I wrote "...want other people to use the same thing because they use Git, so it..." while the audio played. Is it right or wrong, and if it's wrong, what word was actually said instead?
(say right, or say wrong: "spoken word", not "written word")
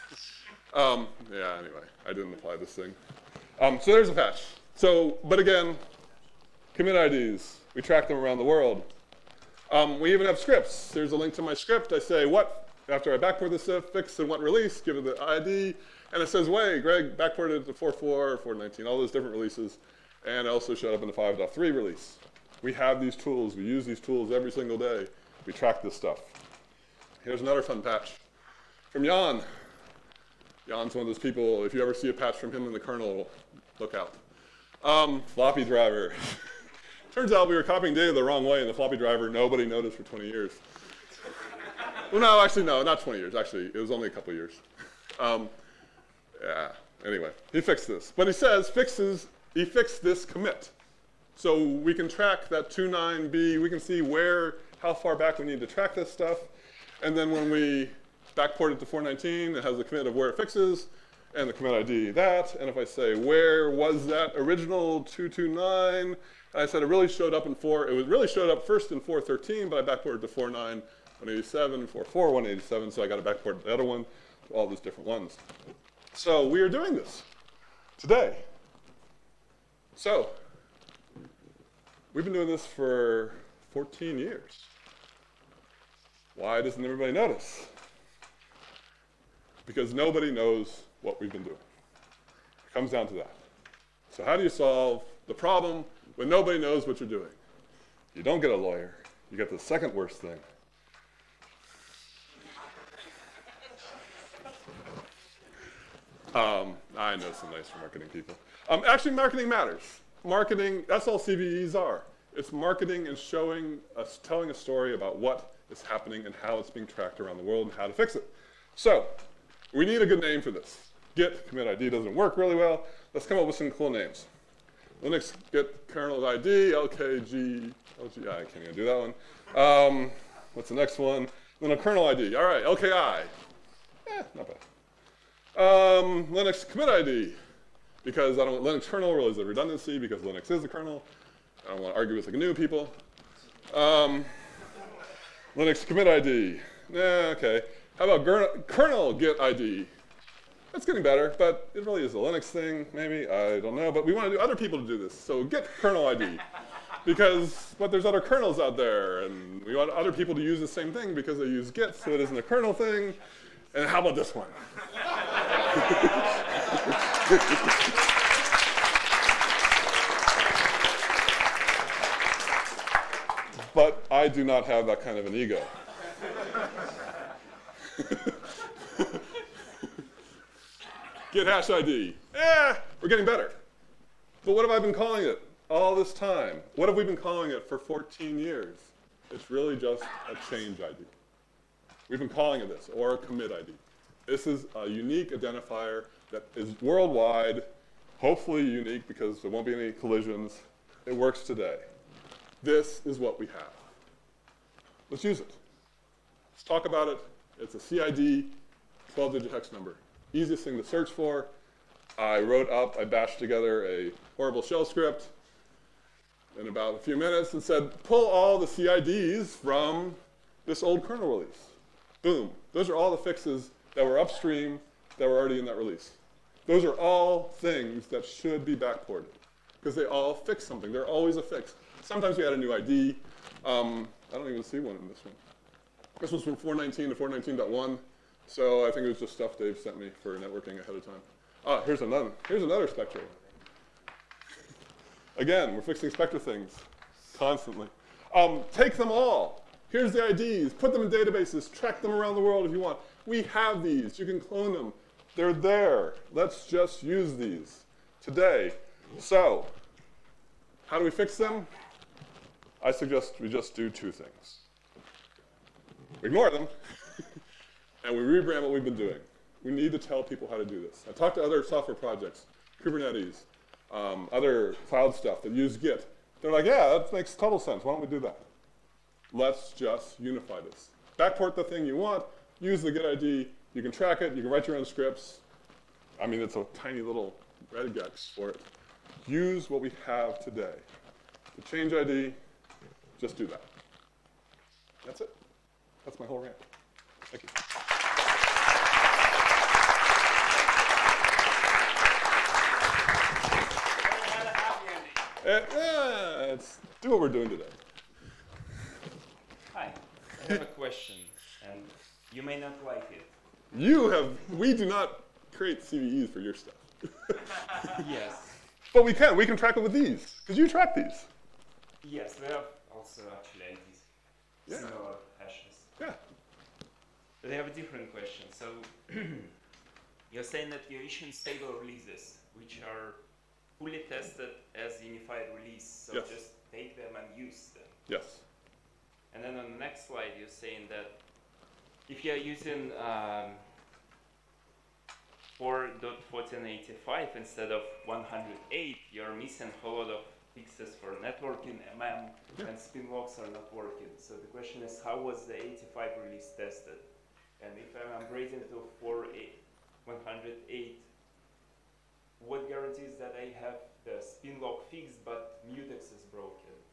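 right.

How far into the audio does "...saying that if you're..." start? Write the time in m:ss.
5:40.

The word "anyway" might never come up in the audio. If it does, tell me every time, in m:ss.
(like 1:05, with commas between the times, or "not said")
0:01, 0:47.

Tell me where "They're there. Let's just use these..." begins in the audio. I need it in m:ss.
4:15.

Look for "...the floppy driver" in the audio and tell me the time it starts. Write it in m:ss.
0:38.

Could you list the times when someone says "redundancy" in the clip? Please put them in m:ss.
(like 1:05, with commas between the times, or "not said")
2:19.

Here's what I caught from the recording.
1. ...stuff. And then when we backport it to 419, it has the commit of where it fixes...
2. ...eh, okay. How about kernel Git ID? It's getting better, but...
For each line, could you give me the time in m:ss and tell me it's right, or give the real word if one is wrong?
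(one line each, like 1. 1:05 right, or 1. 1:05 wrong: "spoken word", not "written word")
1. 0:56 right
2. 2:27 right.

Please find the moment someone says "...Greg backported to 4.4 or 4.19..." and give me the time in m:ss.
0:16.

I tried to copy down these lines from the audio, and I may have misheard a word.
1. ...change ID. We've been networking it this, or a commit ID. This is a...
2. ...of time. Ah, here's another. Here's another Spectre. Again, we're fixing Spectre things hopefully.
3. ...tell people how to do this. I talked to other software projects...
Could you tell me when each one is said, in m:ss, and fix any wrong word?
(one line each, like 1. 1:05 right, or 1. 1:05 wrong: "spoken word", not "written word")
1. 3:10 wrong: "calling", not "networking"
2. 4:00 wrong: "constantly", not "hopefully"
3. 4:29 right.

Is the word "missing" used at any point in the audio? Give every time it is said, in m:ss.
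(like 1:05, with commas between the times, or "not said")
5:49.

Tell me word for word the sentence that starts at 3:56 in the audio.
This one's from 419 to 419.1.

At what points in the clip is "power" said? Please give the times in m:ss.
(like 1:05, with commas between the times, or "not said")
not said.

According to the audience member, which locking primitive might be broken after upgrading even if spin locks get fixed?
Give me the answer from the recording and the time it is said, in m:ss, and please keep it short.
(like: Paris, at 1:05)
mutex, at 6:05.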